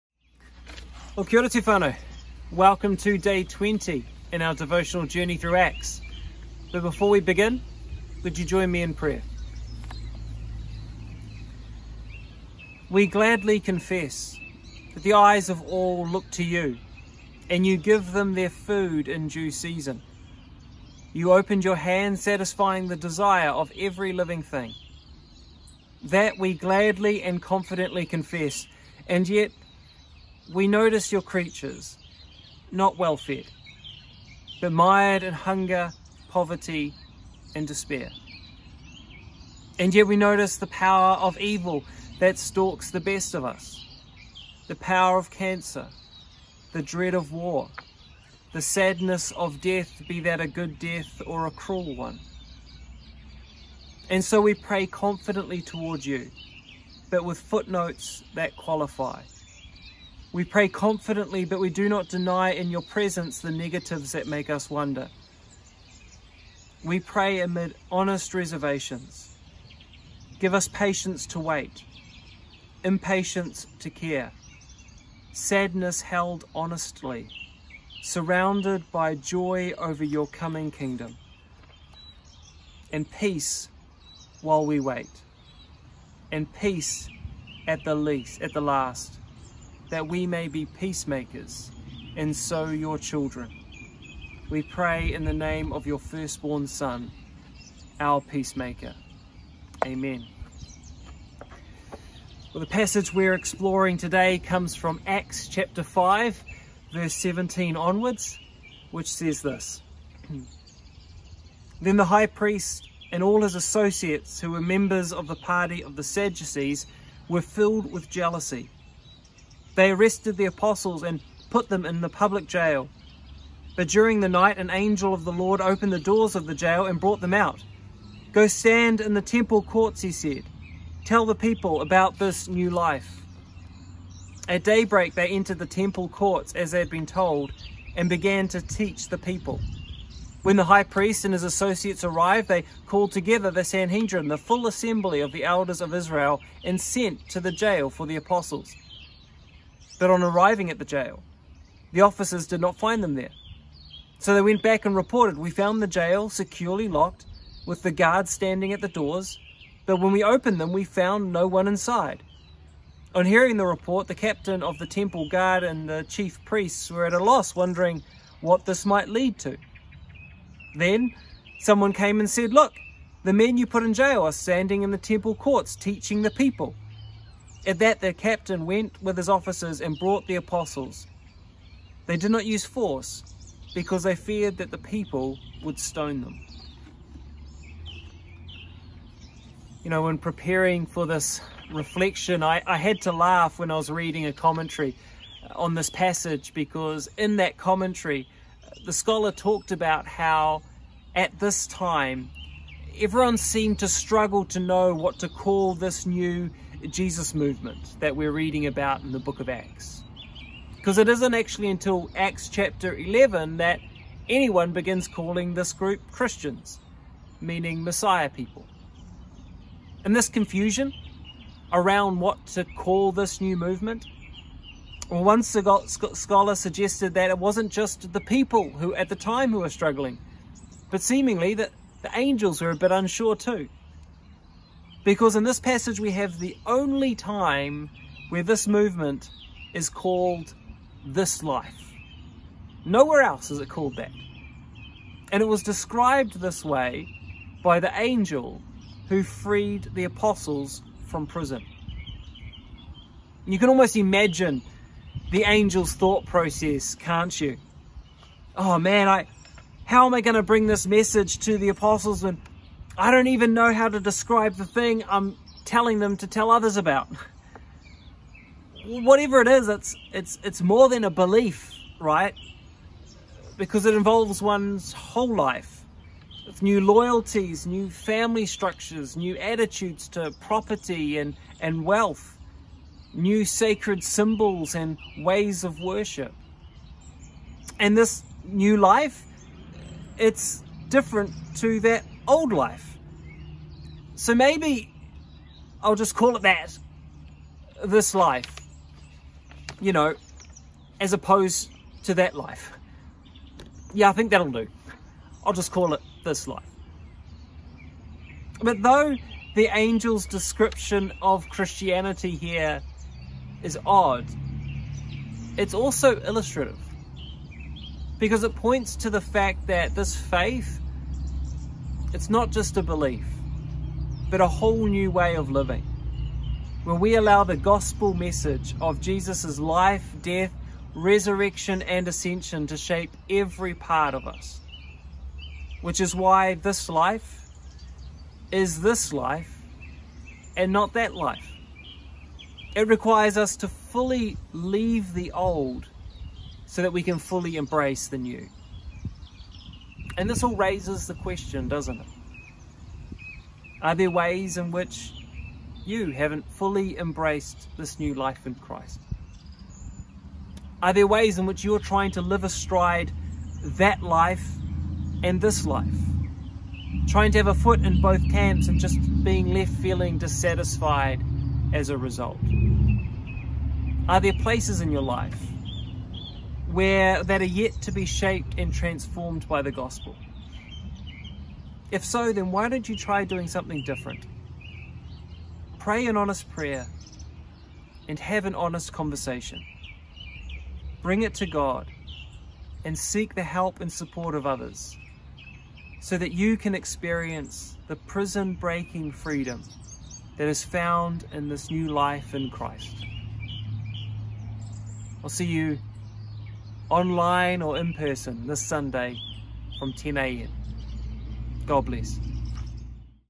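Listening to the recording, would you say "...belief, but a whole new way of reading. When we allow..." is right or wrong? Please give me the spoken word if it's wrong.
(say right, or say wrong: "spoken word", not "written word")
wrong: "living", not "reading".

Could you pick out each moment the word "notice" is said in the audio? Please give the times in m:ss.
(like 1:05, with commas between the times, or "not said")
0:30, 0:40.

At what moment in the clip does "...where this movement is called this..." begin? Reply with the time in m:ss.
3:58.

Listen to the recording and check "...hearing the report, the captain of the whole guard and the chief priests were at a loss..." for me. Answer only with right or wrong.
wrong.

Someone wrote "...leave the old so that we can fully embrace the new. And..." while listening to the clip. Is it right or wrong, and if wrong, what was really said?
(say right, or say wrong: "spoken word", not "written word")
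right.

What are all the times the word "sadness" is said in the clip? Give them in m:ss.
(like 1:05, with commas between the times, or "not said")
0:48, 1:15.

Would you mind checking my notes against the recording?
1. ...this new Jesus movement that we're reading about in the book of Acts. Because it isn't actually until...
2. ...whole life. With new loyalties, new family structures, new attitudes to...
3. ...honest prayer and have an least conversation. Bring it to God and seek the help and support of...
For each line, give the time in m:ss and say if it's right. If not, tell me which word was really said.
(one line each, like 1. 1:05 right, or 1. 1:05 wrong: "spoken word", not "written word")
1. 3:25 right
2. 4:34 right
3. 6:26 wrong: "honest", not "least".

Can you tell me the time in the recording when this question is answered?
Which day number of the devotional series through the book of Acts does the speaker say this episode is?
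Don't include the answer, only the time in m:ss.
0:03.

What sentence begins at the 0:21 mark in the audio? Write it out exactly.
You opened your hand, satisfying the desire of every living thing.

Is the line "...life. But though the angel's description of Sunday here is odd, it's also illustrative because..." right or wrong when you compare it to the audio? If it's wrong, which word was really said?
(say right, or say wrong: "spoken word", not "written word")
wrong: "Christianity", not "Sunday".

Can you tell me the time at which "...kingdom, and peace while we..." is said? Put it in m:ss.
1:20.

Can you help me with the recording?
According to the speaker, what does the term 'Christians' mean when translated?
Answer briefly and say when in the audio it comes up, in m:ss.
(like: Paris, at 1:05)
Messiah people, at 3:37.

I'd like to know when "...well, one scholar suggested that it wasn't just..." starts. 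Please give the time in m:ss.
3:45.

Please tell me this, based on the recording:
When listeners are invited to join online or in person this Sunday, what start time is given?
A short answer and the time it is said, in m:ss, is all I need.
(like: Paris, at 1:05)
10 a.m., at 6:49.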